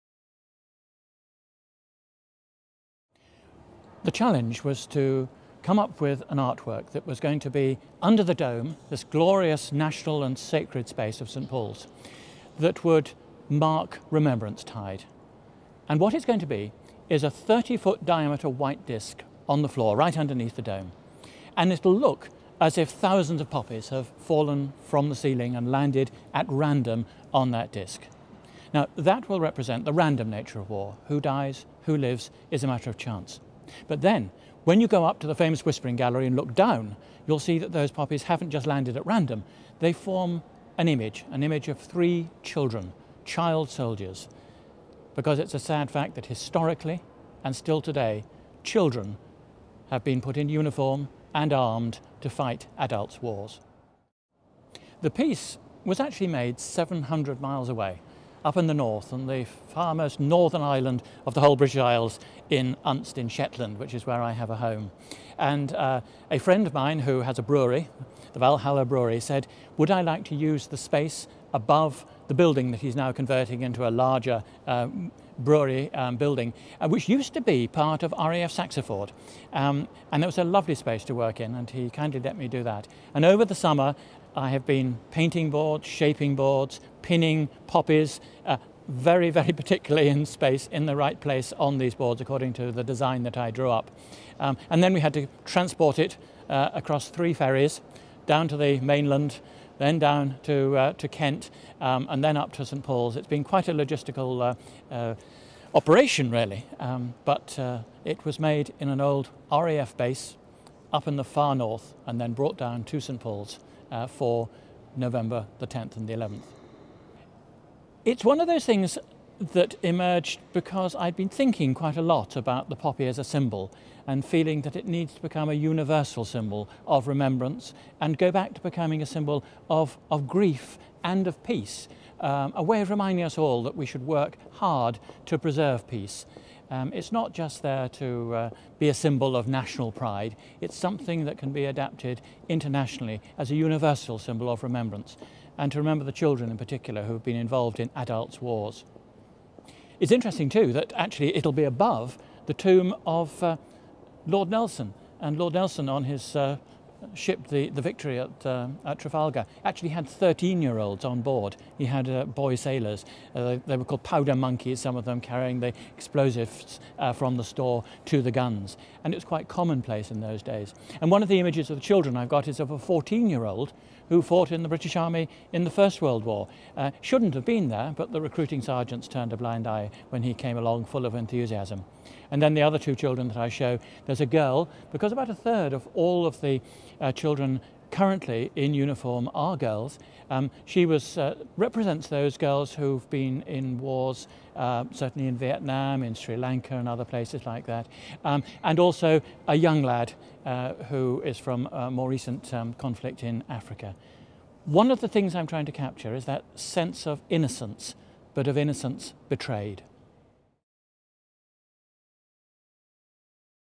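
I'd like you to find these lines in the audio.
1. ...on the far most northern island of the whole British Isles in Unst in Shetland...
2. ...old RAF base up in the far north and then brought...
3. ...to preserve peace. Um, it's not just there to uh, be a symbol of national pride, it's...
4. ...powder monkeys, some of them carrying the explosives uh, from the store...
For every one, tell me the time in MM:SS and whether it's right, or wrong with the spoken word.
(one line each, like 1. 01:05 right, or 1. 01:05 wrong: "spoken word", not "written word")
1. 00:59 right
2. 01:49 right
3. 02:15 right
4. 02:44 right.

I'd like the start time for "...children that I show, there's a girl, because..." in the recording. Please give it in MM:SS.
03:02.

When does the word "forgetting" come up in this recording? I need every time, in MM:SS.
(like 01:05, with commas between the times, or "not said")
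not said.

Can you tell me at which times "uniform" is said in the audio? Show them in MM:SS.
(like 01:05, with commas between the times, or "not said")
00:50, 03:08.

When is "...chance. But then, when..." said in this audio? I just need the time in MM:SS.
00:32.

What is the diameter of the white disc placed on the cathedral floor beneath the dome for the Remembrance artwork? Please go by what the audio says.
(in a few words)
30 feet.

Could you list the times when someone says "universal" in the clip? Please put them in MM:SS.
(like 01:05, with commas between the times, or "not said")
02:05, 02:23.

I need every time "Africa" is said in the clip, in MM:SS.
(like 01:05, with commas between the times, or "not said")
03:23.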